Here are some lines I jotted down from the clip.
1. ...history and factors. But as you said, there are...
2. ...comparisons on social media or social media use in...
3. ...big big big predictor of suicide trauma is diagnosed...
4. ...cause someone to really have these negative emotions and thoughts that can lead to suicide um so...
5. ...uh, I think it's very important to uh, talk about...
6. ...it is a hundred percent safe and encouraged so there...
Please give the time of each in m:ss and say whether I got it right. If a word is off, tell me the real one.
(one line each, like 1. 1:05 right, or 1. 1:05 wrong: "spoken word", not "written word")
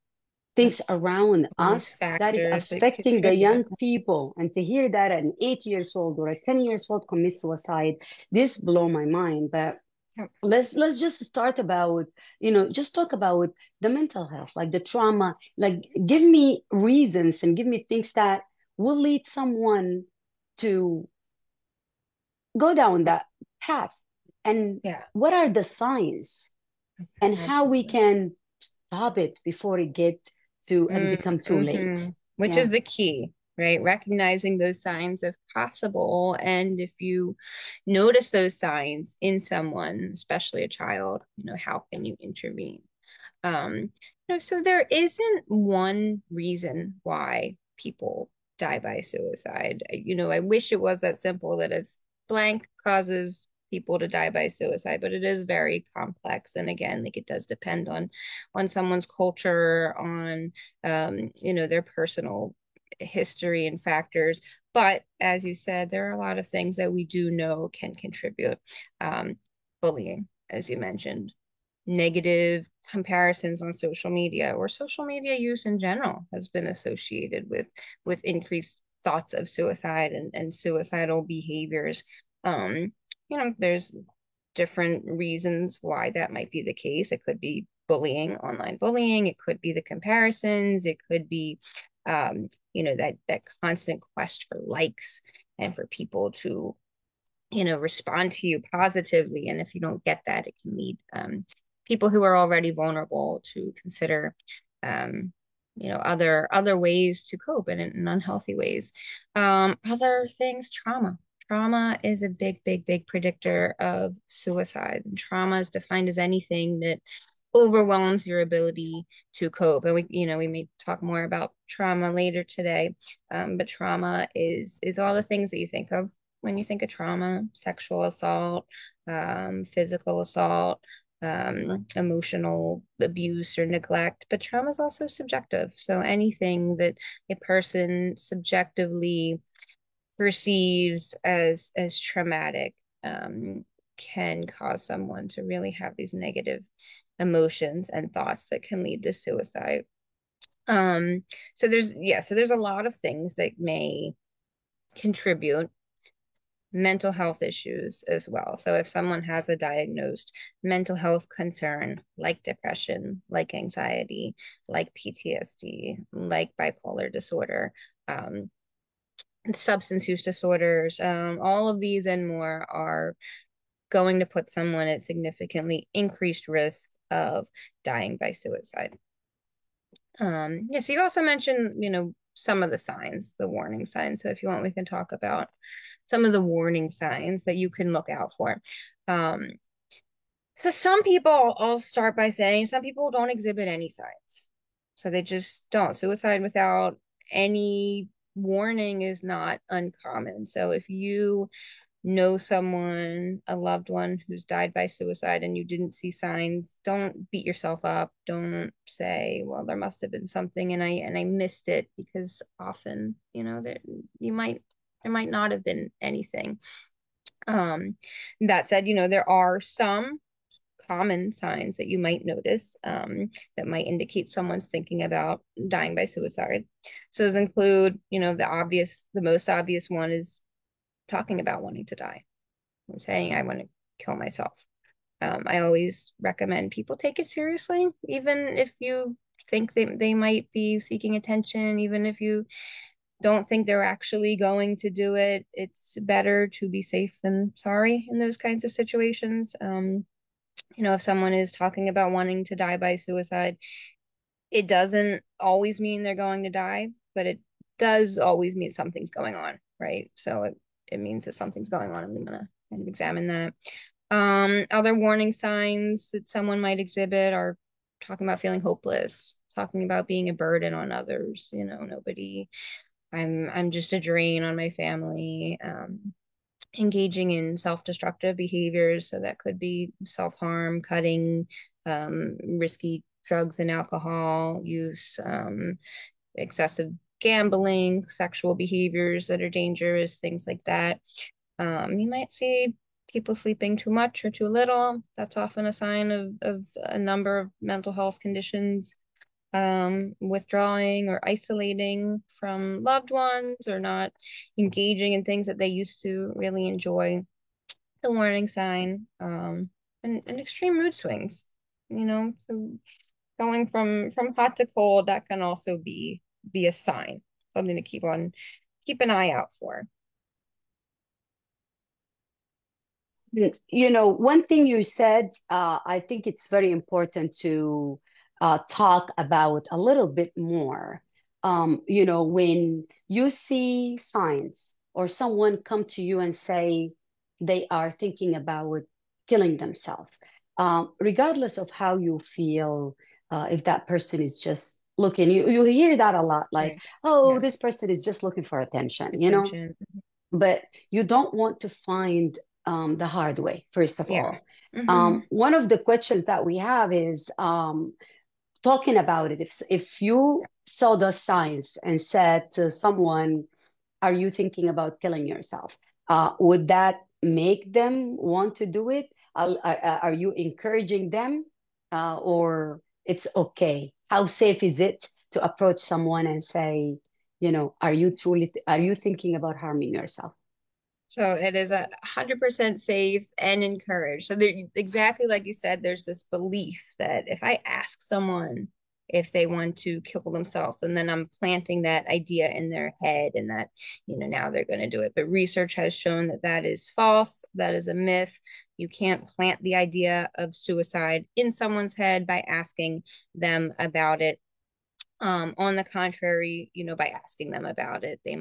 1. 1:02 right
2. 1:12 right
3. 1:52 wrong: "defined", not "diagnosed"
4. 2:24 right
5. 5:25 right
6. 6:21 right.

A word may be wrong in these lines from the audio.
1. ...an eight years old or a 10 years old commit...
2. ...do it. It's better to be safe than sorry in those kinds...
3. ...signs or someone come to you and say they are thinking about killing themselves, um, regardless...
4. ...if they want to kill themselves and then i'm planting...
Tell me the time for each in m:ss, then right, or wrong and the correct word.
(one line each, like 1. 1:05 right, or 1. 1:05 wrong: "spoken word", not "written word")
1. 0:05 right
2. 4:04 right
3. 5:33 right
4. 6:29 right.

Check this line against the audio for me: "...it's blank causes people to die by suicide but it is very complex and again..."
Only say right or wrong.
right.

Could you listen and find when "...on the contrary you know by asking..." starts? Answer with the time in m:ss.
6:45.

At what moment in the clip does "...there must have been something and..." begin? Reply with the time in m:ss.
3:29.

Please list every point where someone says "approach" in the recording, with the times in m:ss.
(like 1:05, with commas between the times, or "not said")
6:15.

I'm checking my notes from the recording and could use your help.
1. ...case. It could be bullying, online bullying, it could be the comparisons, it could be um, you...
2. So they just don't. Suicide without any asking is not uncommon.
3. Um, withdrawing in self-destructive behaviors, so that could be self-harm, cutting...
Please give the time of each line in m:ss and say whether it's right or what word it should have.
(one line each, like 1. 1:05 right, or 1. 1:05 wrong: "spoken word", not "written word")
1. 1:26 right
2. 3:14 wrong: "warning", not "asking"
3. 4:35 wrong: "engaging", not "withdrawing".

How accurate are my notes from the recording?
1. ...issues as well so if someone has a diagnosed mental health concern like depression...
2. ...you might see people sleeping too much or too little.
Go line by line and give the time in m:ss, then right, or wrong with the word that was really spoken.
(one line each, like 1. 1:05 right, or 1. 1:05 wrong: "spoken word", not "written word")
1. 2:37 right
2. 4:51 right.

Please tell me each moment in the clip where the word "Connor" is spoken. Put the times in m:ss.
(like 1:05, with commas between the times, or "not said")
not said.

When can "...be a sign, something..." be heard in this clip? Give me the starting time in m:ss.
5:16.